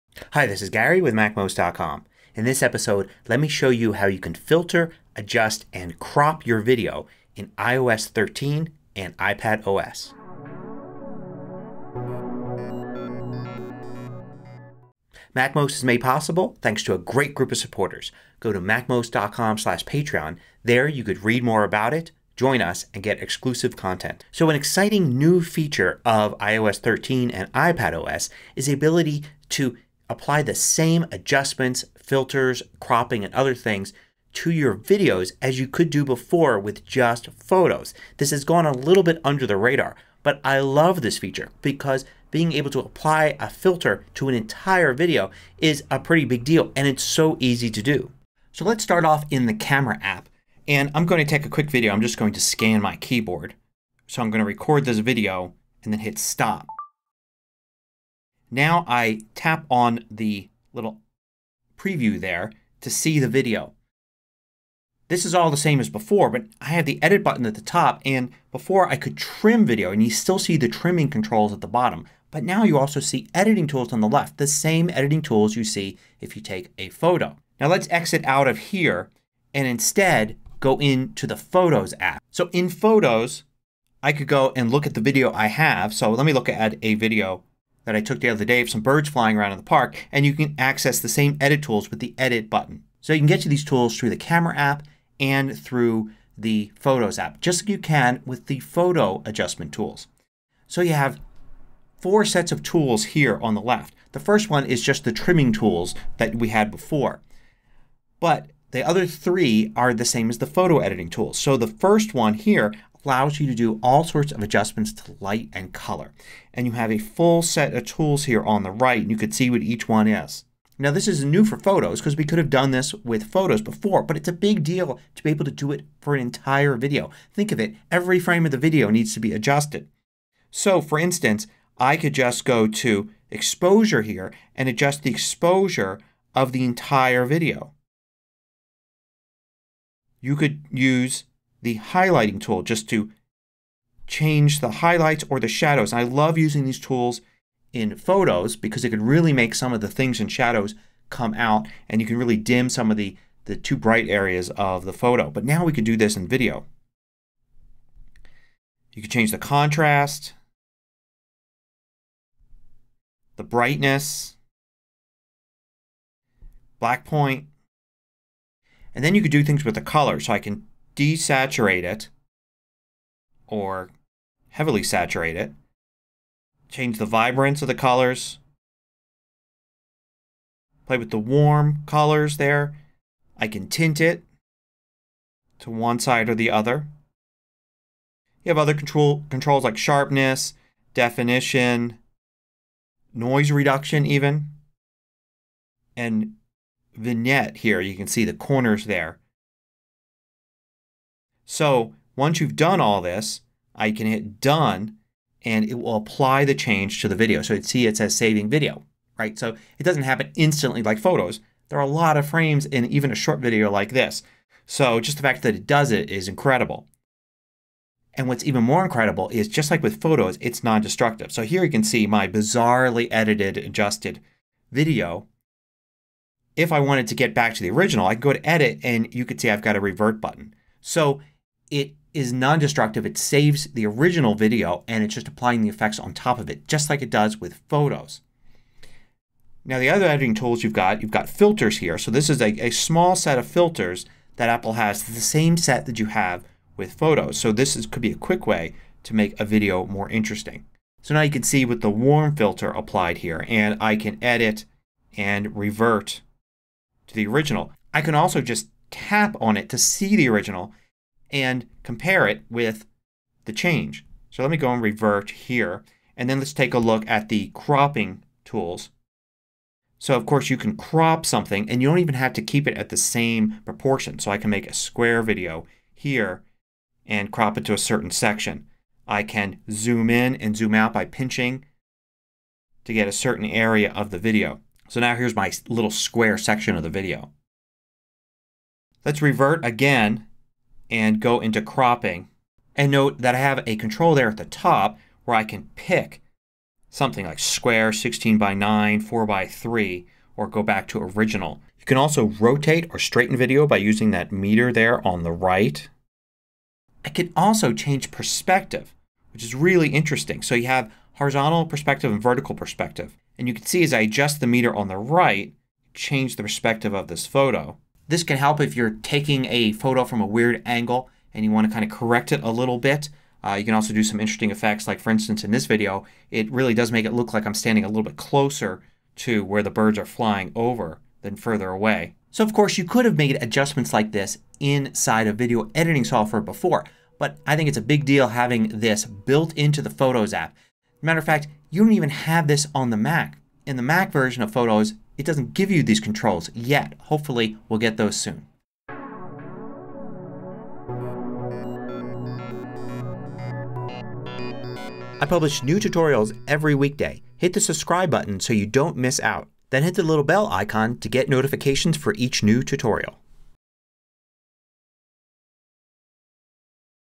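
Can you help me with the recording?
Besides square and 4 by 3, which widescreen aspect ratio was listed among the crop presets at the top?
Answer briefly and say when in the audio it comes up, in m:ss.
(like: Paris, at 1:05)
16 by 9, at 4:57.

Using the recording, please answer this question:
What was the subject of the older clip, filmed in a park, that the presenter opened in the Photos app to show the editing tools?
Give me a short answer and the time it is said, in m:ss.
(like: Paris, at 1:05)
Birds flying, at 1:28.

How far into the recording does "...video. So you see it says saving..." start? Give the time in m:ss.
3:27.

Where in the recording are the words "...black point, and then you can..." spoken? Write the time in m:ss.
2:46.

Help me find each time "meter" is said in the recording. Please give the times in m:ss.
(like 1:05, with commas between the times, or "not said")
5:04, 5:14.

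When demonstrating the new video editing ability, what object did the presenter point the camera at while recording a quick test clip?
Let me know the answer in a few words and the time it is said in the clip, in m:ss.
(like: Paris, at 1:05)
Keyboard, at 0:52.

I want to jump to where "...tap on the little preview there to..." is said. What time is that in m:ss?
0:59.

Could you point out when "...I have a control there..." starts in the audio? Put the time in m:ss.
4:53.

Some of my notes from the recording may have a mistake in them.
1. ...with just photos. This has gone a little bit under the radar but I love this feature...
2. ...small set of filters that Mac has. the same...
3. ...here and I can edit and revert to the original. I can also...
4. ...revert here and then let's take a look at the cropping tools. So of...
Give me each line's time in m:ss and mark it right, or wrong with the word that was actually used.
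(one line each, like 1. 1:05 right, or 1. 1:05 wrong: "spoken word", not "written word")
1. 0:36 right
2. 4:02 wrong: "Apple", not "Mac"
3. 4:13 right
4. 4:24 right.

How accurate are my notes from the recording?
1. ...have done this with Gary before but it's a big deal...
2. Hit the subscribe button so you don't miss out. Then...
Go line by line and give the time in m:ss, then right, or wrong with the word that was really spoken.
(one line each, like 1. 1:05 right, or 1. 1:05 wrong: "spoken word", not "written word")
1. 2:02 wrong: "Photos", not "Gary"
2. 5:57 right.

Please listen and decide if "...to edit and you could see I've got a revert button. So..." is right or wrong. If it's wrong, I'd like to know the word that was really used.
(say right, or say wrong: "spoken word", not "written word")
right.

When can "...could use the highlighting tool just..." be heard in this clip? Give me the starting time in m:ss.
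2:20.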